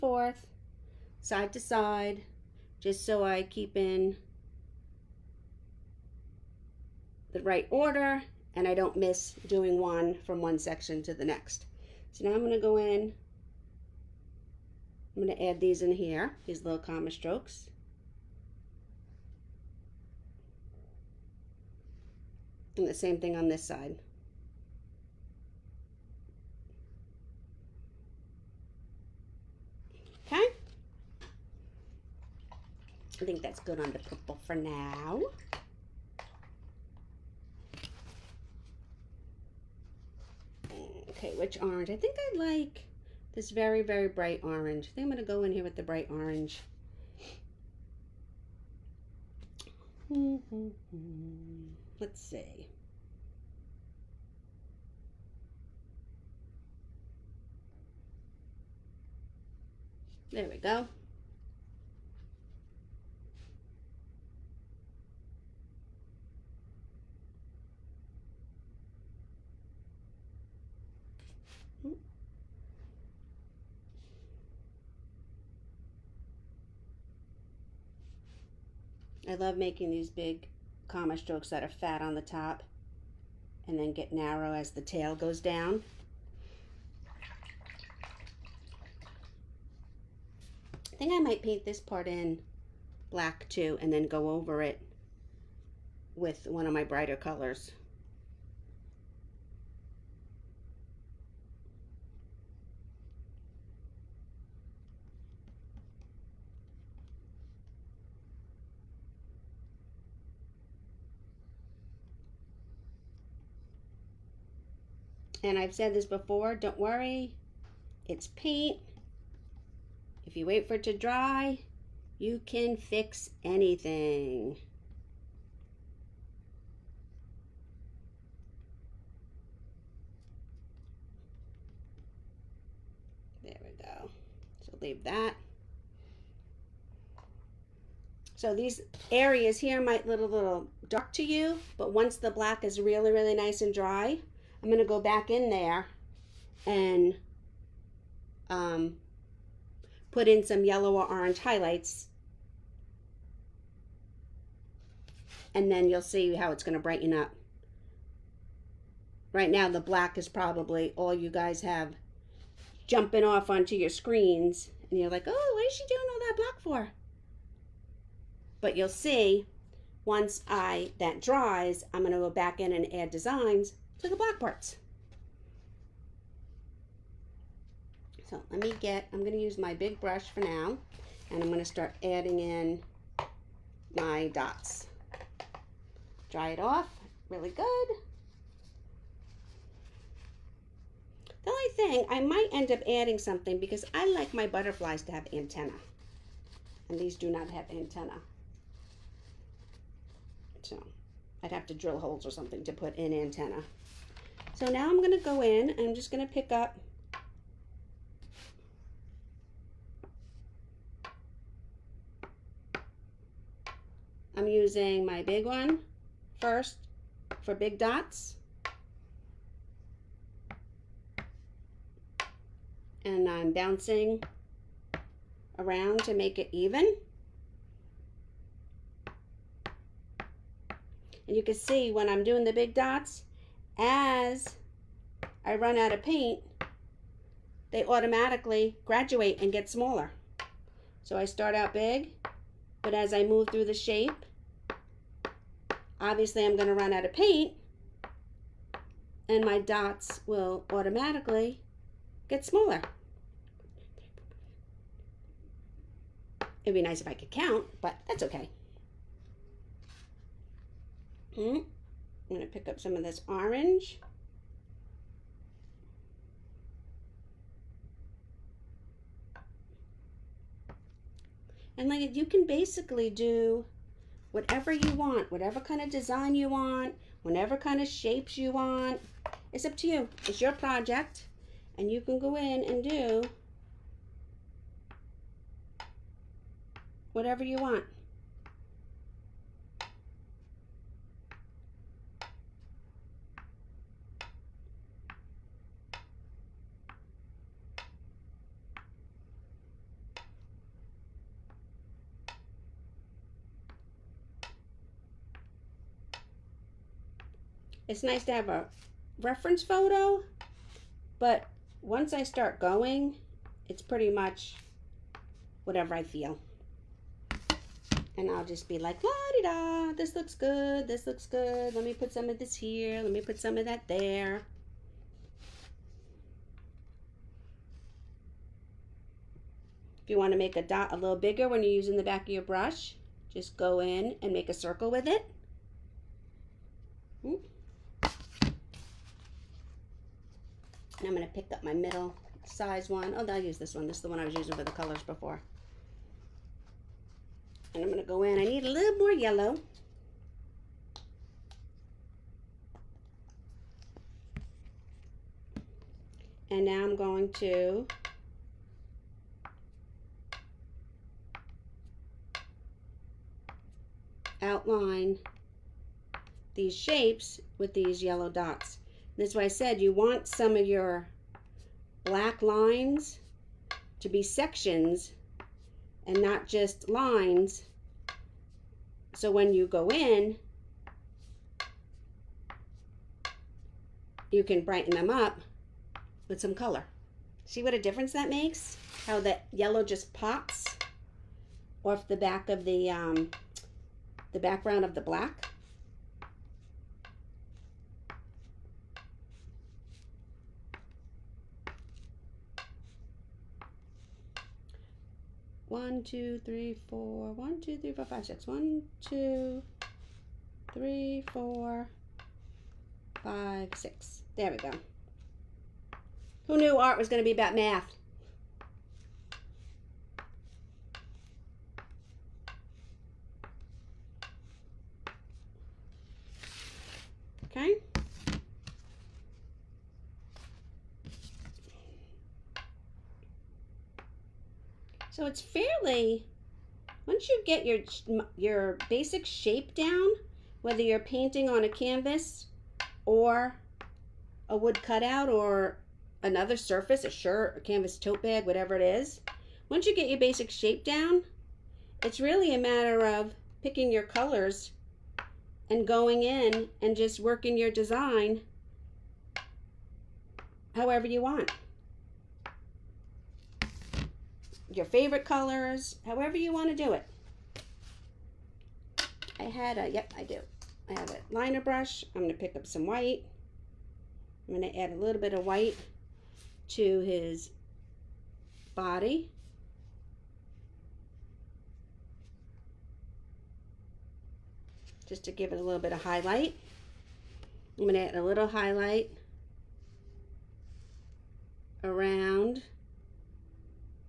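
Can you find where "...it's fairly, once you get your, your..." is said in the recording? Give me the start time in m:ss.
7:15.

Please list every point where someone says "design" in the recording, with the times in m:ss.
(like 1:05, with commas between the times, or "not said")
2:53, 4:35, 7:37.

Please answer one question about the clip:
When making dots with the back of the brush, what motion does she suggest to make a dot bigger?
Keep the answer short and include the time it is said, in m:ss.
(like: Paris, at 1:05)
make a circle, at 5:34.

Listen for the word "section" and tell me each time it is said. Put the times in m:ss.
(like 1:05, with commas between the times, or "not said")
0:10, 6:14.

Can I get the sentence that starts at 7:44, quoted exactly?
your favorite colors, however you want to do it.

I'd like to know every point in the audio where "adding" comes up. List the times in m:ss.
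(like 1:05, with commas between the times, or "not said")
3:02, 3:12.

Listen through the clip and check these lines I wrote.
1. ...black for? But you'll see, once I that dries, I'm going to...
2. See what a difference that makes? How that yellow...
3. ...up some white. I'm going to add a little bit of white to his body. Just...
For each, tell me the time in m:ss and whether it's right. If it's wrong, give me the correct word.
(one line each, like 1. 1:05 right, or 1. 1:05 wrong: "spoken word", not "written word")
1. 2:46 right
2. 6:27 right
3. 7:52 right.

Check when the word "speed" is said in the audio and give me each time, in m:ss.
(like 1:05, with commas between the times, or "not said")
not said.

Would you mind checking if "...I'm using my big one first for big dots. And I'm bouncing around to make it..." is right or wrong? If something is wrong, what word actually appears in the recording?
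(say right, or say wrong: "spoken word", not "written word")
right.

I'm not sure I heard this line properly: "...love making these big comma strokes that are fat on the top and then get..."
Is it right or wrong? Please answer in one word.
right.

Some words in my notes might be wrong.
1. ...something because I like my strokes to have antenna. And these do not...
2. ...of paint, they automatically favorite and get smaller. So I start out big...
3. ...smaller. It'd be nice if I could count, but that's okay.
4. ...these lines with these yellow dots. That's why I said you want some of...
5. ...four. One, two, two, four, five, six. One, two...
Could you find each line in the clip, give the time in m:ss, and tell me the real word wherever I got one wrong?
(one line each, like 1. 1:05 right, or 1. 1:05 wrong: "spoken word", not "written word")
1. 3:13 wrong: "butterflies", not "strokes"
2. 3:55 wrong: "graduate", not "favorite"
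3. 4:12 right
4. 6:06 wrong: "shapes", not "lines"
5. 6:46 wrong: "three", not "two".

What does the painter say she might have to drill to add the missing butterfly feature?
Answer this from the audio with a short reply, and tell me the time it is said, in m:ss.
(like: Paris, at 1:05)
holes, at 3:21.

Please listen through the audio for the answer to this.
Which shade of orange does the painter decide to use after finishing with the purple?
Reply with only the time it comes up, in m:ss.
0:43.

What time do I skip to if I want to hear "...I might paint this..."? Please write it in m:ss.
1:31.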